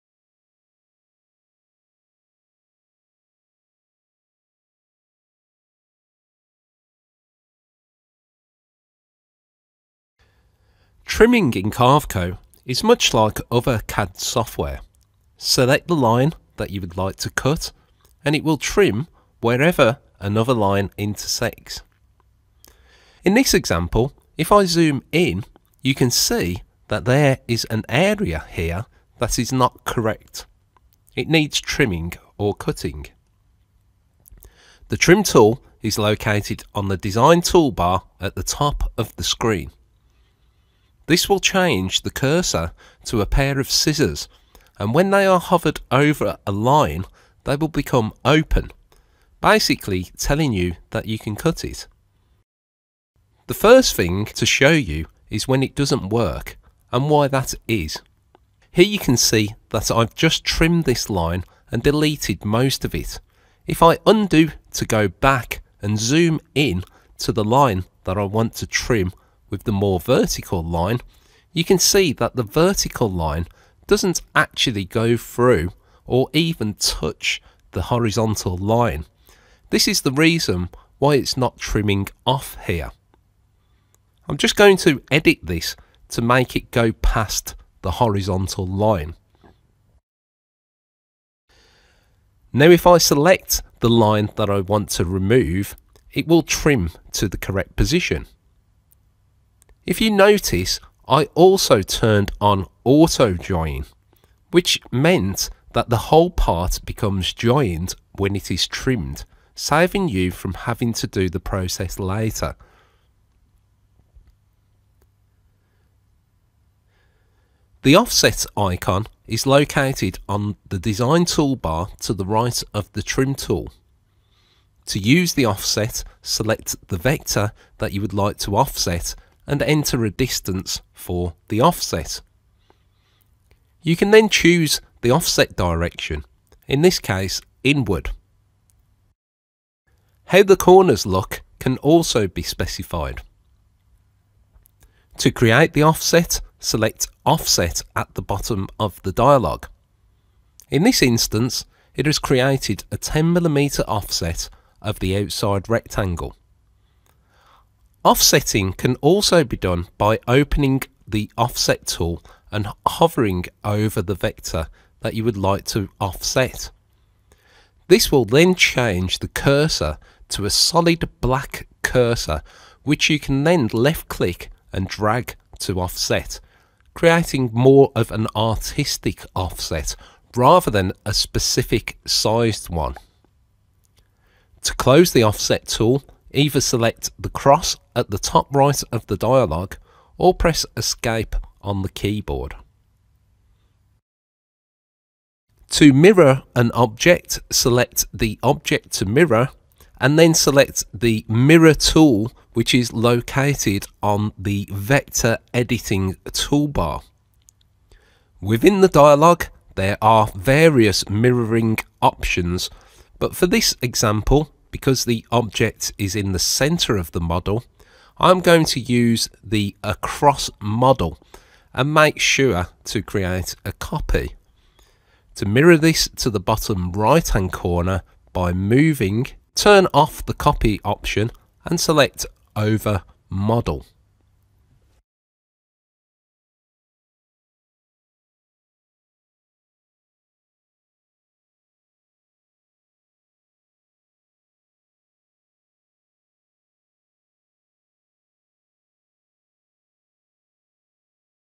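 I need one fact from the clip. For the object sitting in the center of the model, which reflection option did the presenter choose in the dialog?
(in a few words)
Across model.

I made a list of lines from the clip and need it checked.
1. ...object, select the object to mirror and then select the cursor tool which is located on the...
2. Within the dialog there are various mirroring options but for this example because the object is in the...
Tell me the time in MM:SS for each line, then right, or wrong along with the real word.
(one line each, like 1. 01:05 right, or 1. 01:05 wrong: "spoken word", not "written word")
1. 03:16 wrong: "mirror", not "cursor"
2. 03:28 right.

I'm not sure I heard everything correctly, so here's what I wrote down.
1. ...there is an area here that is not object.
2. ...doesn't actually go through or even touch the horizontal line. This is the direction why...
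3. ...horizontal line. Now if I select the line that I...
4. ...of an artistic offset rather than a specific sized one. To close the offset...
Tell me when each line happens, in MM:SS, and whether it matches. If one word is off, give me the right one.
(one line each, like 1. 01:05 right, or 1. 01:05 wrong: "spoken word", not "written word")
1. 00:27 wrong: "correct", not "object"
2. 01:13 wrong: "reason", not "direction"
3. 01:27 right
4. 02:57 right.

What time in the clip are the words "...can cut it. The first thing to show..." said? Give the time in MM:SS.
00:51.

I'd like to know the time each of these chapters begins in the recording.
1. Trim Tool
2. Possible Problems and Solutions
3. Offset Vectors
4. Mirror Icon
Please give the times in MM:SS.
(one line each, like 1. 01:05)
1. 00:33
2. 00:52
3. 01:55
4. 03:14.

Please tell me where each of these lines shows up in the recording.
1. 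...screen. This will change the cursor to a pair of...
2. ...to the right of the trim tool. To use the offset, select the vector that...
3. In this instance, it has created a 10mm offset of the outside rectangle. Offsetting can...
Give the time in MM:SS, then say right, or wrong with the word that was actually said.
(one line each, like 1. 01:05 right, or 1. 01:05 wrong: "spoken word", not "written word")
1. 00:39 right
2. 02:02 right
3. 02:30 right.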